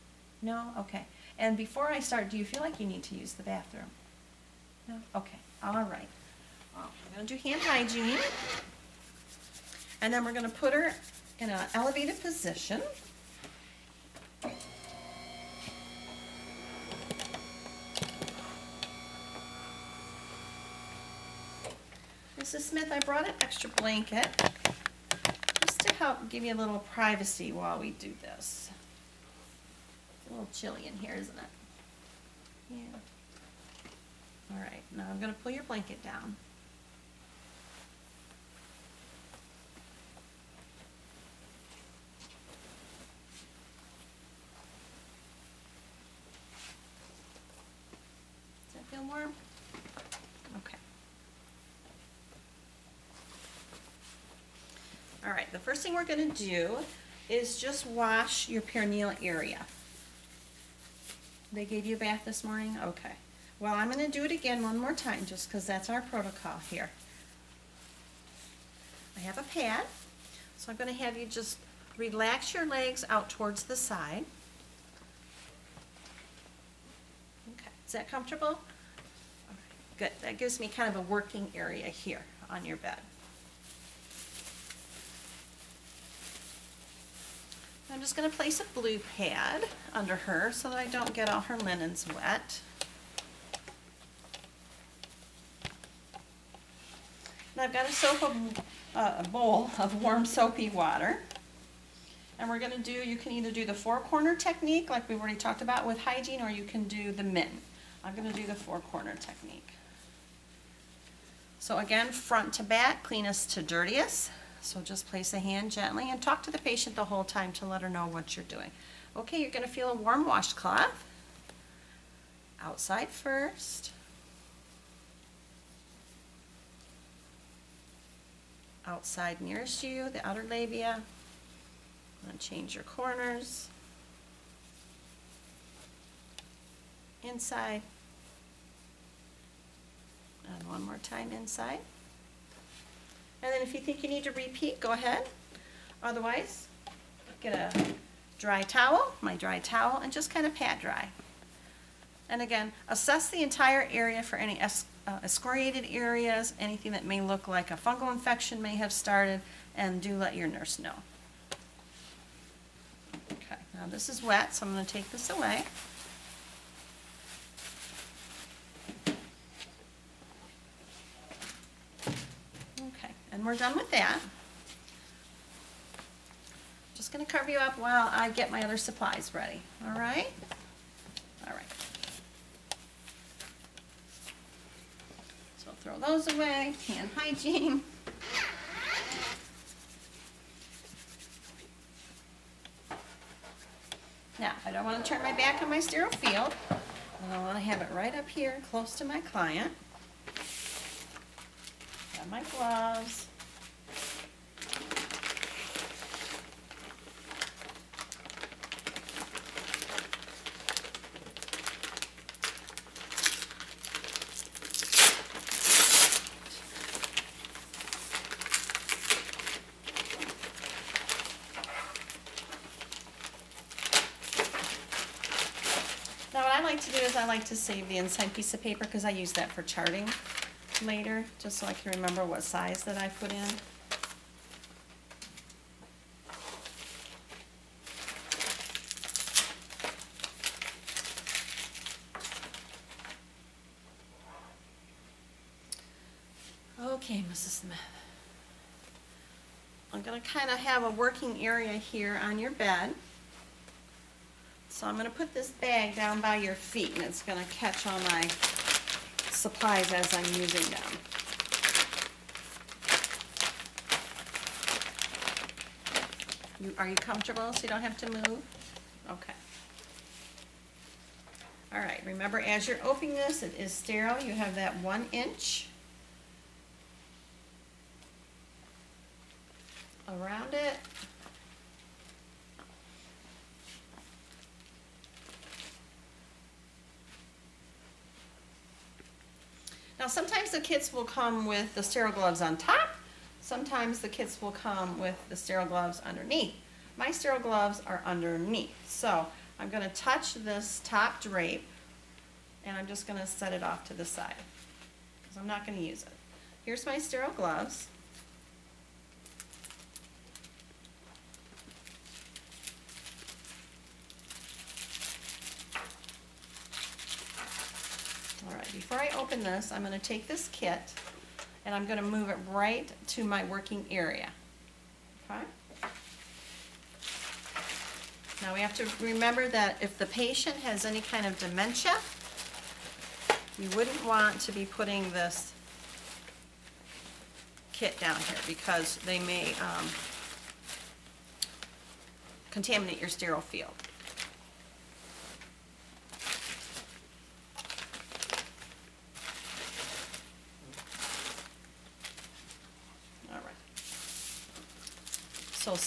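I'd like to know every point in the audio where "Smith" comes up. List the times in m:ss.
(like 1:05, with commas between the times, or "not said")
0:22, 4:07.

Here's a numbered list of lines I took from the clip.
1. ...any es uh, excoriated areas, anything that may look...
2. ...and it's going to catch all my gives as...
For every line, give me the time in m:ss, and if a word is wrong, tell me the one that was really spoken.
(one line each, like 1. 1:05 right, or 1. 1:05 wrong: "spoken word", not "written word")
1. 2:34 right
2. 4:16 wrong: "supplies", not "gives".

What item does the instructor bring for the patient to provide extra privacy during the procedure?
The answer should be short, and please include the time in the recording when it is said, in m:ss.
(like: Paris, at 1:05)
extra blanket, at 0:23.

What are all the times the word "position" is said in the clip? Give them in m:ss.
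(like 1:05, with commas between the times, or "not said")
0:12.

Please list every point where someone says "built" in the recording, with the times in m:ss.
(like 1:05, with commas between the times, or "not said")
not said.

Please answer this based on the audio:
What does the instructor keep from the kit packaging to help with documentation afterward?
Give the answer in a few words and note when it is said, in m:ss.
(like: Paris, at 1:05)
inside piece of paper, at 3:47.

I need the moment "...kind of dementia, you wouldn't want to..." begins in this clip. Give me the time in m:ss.
5:31.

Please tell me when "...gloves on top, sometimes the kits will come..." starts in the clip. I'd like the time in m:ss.
4:52.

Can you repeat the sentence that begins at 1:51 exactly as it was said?
So again, front to back, cleanest to dirtiest.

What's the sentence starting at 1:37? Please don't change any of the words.
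And I've got a soap, a, uh, a bowl of warm soapy water.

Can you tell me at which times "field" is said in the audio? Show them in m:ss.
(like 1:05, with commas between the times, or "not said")
3:16, 5:43.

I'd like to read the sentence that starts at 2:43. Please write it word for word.
Okay, now this is wet, so I'm going to take this away.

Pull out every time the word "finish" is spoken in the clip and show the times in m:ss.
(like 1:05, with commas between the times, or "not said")
not said.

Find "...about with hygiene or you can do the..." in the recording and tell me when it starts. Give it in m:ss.
1:45.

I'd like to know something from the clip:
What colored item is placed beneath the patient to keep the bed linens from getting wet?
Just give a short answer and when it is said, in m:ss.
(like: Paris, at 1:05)
blue pad, at 1:28.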